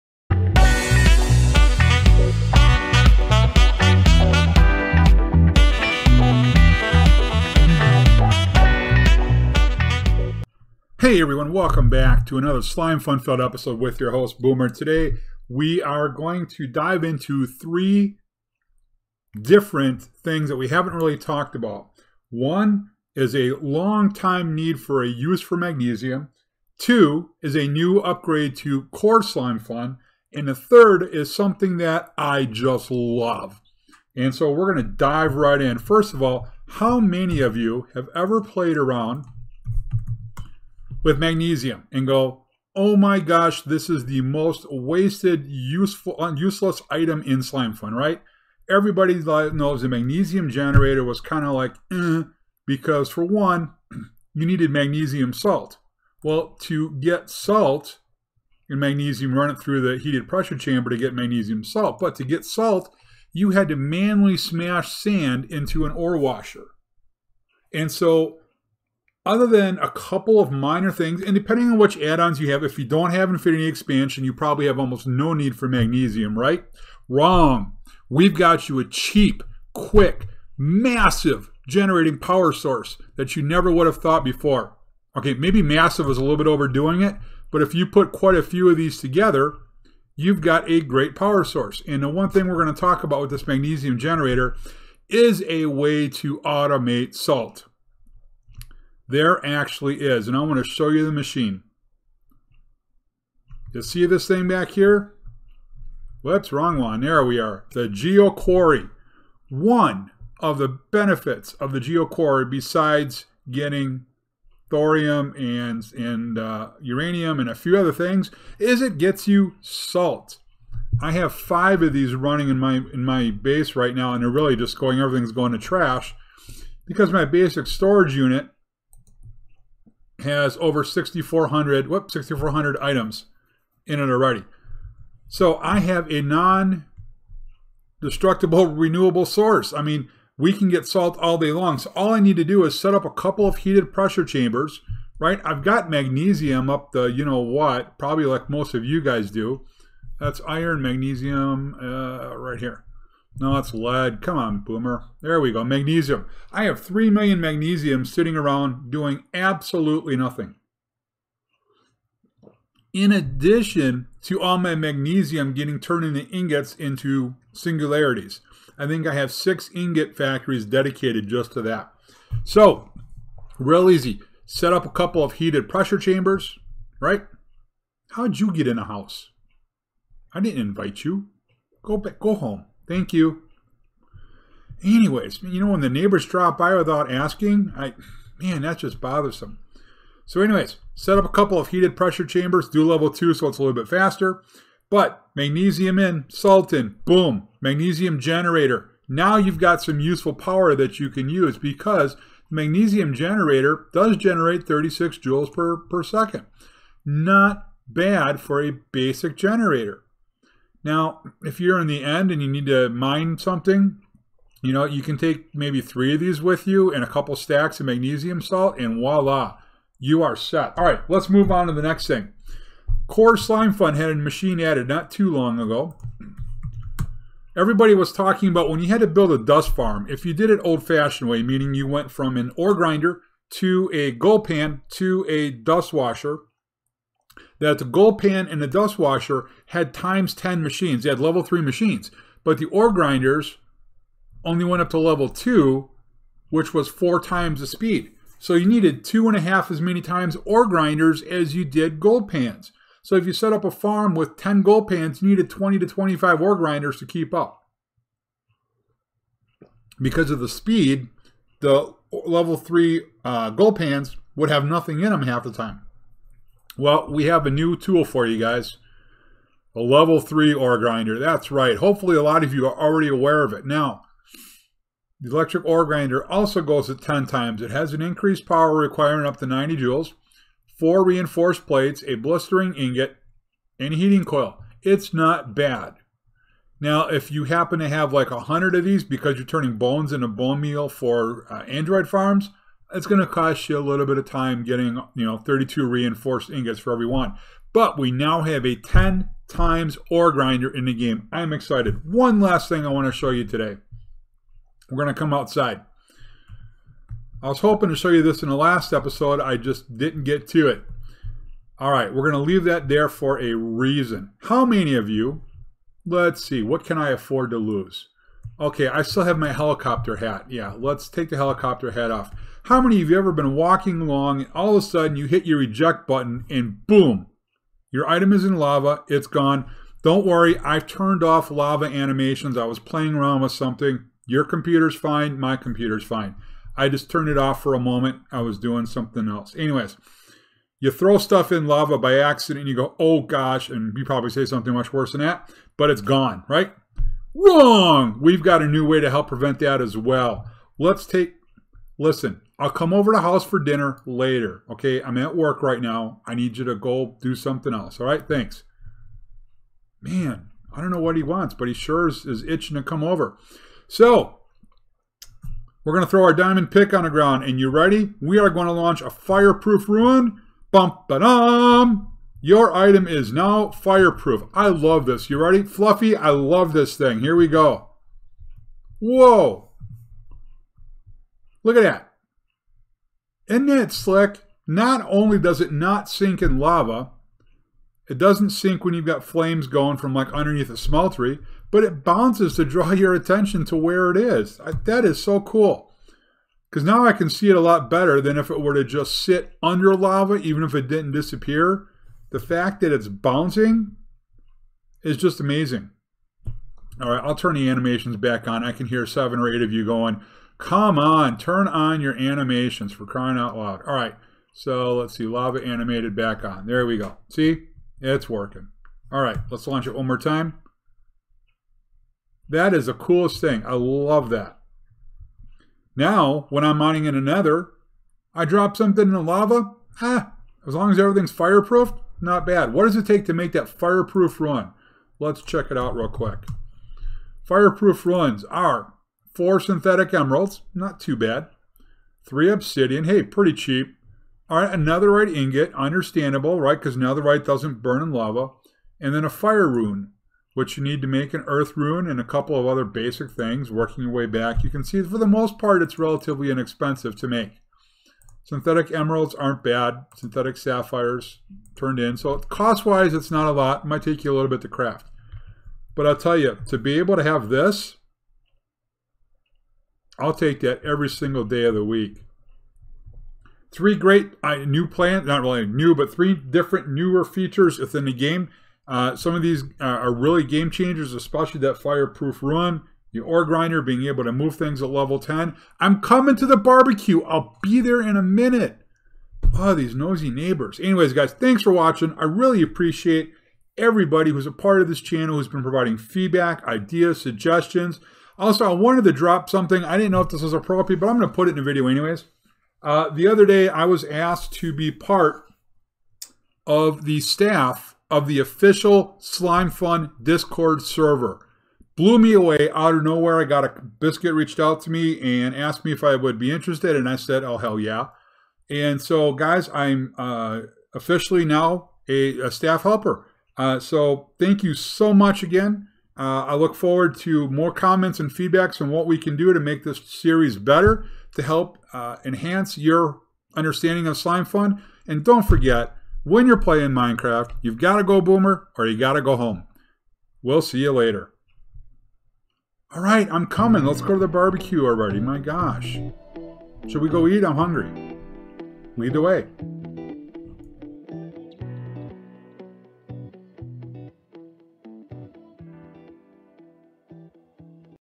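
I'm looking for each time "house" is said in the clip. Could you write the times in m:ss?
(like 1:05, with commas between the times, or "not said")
2:58, 5:53.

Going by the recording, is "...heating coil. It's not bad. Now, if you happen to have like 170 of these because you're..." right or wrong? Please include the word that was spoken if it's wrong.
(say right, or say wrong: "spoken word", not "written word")
wrong: "100", not "170".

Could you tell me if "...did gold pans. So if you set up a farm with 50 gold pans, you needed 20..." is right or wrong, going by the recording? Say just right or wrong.
wrong.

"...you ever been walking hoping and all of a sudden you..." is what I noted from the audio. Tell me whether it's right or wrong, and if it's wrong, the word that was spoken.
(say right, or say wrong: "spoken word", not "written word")
wrong: "along", not "hoping".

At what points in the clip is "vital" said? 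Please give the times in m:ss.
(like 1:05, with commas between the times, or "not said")
not said.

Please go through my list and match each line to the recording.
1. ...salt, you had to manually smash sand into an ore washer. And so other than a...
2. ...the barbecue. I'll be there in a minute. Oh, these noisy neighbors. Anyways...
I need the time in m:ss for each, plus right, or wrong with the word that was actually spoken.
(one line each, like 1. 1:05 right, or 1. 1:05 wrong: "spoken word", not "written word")
1. 1:02 right
2. 8:06 right.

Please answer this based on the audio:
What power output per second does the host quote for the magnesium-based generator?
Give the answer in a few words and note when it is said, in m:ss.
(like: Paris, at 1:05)
36 joules, at 3:24.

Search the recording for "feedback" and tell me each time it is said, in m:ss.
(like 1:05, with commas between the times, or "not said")
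8:15, 8:48.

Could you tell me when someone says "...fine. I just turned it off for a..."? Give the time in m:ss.
5:36.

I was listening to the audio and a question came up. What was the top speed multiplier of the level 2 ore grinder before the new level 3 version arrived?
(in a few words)
4 times.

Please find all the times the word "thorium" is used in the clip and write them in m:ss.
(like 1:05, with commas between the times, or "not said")
1:54.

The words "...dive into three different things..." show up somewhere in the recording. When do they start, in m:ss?
0:16.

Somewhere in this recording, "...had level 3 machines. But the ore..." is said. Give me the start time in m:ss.
4:01.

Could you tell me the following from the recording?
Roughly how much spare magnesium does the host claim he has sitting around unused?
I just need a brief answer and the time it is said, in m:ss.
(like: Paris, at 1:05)
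3 million, at 2:36.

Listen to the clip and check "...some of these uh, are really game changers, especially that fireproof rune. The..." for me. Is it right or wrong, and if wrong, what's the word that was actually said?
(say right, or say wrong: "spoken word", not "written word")
right.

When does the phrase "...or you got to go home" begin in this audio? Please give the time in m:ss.
8:58.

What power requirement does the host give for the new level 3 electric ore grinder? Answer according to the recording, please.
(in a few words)
90 joules.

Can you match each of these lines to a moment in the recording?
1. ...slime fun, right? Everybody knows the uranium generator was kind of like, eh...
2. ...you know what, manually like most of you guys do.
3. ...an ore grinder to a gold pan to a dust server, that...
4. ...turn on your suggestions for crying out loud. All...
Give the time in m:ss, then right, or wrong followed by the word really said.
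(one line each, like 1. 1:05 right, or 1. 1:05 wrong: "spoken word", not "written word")
1. 0:47 wrong: "magnesium", not "uranium"
2. 2:27 wrong: "probably", not "manually"
3. 3:52 wrong: "washer", not "server"
4. 6:51 wrong: "animations", not "suggestions".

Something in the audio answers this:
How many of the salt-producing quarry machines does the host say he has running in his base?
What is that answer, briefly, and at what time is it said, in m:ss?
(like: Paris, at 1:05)
5, at 2:01.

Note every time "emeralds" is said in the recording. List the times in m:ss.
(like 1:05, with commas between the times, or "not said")
7:20, 7:38.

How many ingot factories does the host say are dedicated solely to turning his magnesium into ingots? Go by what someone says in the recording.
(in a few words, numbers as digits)
6.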